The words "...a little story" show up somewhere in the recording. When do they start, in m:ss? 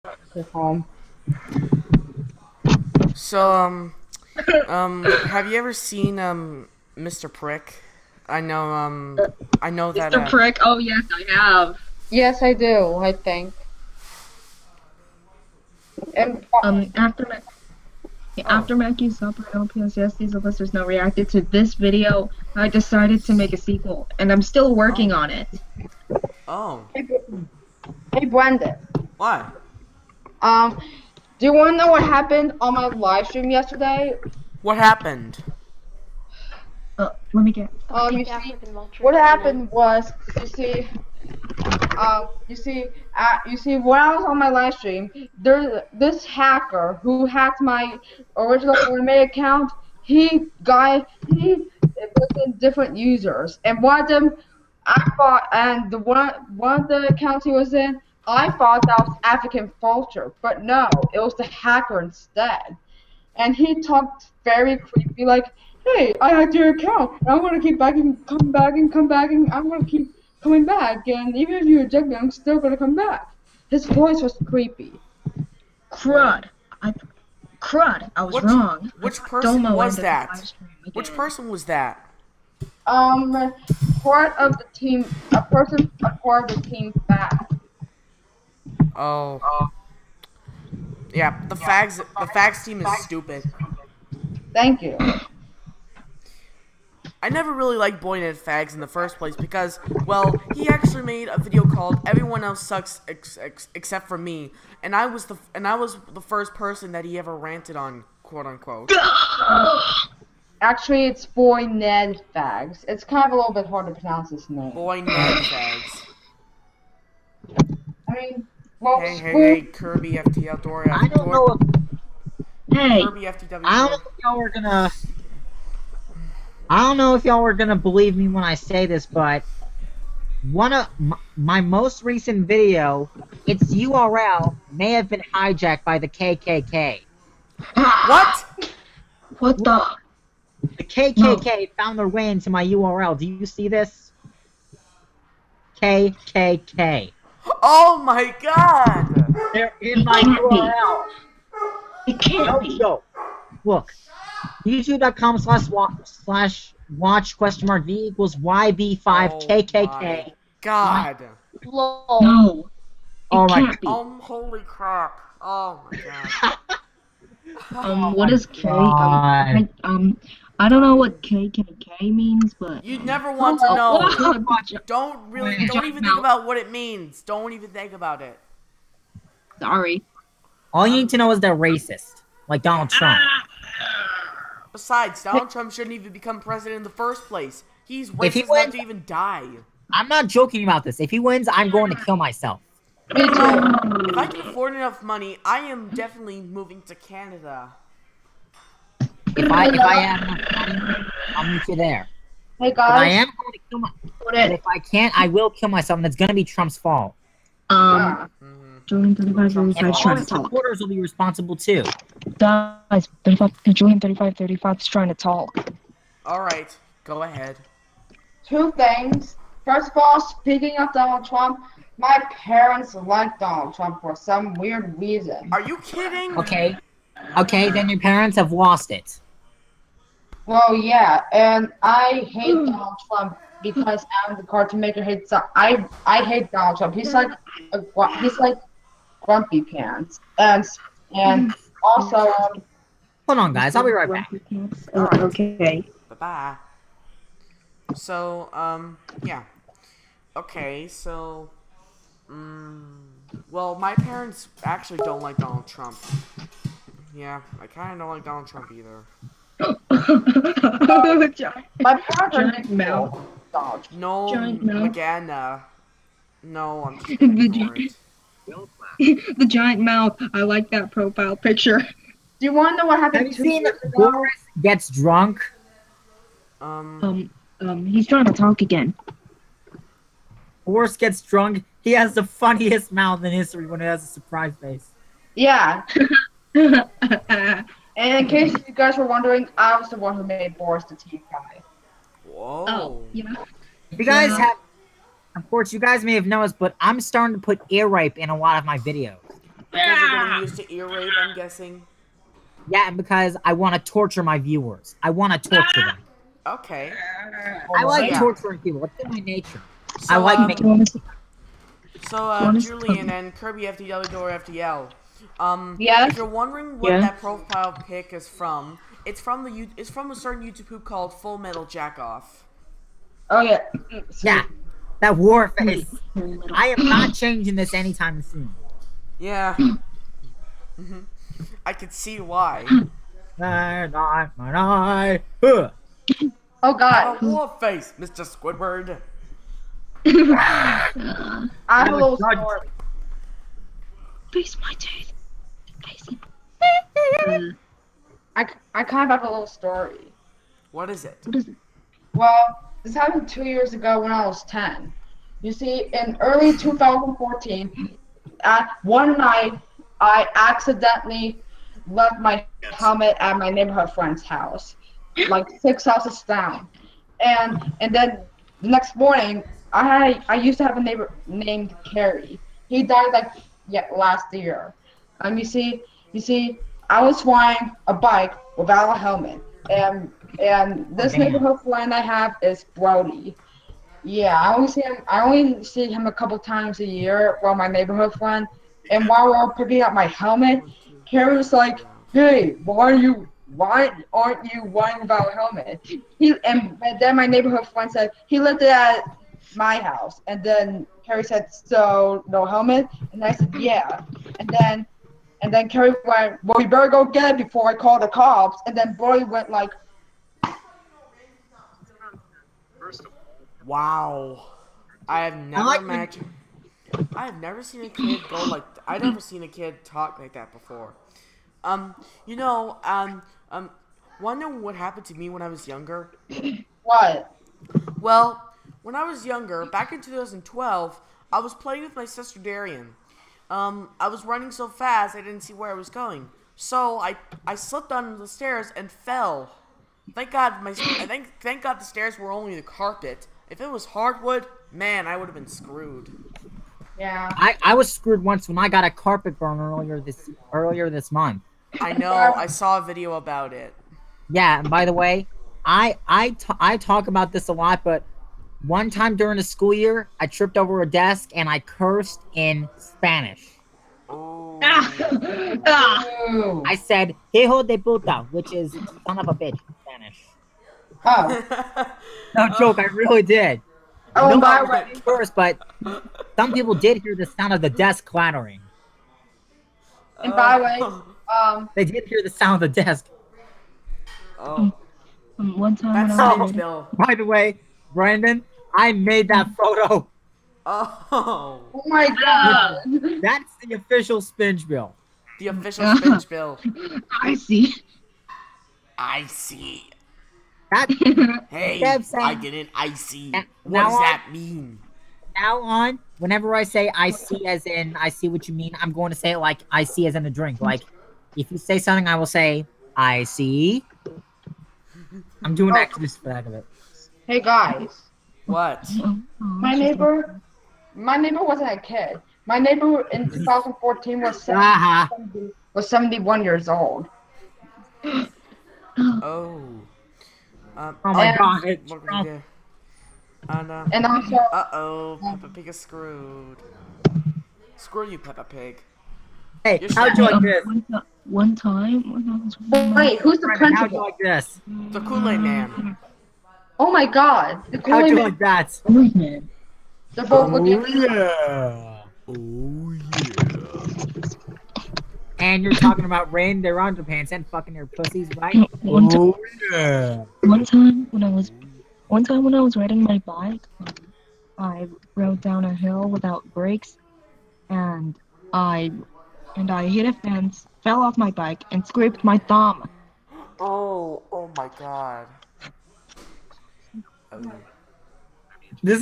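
5:49.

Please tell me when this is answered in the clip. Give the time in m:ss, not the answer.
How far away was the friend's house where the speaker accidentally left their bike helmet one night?
6:05.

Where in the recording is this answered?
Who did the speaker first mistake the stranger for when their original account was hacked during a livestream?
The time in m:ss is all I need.
0:59.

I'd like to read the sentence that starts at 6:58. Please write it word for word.
I've never seen a kid talk like that before.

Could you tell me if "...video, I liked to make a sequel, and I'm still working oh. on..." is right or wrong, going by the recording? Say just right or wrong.
wrong.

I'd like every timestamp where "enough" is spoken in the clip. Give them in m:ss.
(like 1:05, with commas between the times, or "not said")
3:08, 3:14.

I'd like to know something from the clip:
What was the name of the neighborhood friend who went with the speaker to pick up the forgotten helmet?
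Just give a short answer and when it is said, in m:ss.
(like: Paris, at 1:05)
Brody, at 6:22.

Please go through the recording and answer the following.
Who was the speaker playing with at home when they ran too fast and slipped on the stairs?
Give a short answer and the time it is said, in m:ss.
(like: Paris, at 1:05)
Darian, at 7:12.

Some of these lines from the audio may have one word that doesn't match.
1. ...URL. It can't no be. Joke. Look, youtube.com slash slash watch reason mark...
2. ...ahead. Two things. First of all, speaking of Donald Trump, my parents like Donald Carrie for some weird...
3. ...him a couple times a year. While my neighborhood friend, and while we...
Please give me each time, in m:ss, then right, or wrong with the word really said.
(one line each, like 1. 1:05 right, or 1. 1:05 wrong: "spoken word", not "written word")
1. 2:30 wrong: "question", not "reason"
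2. 3:37 wrong: "Trump", not "Carrie"
3. 6:25 right.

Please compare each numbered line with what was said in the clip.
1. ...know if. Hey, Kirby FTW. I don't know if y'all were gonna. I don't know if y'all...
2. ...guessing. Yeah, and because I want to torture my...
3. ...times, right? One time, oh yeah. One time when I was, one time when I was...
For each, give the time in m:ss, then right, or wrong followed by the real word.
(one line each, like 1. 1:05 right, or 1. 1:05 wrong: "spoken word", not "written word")
1. 2:01 right
2. 5:01 right
3. 9:17 wrong: "pussies", not "times".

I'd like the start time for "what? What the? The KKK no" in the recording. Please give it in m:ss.
2:18.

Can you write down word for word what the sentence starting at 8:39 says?
My neighbor, my neighbor wasn't a kid.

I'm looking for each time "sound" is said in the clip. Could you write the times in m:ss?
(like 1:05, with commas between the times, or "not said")
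7:57, 8:02.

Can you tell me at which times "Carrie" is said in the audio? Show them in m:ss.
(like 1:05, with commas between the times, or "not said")
6:11, 6:41, 6:45.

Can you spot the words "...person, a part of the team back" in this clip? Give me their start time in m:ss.
1:25.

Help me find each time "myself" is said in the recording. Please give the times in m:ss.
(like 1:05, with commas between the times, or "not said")
3:12, 3:25.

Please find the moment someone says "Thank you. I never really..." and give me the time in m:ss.
1:34.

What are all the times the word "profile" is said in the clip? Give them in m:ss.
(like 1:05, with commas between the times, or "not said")
4:30, 5:17.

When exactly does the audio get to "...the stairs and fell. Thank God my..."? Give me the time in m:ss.
7:18.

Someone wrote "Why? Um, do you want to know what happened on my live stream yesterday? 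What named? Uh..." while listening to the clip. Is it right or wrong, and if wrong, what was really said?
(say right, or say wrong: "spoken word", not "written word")
wrong: "happened", not "named".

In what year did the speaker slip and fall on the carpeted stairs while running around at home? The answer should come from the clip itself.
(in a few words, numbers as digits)
2012.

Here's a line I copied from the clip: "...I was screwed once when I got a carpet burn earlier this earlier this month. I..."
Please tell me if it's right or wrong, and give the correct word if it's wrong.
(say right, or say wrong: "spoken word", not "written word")
right.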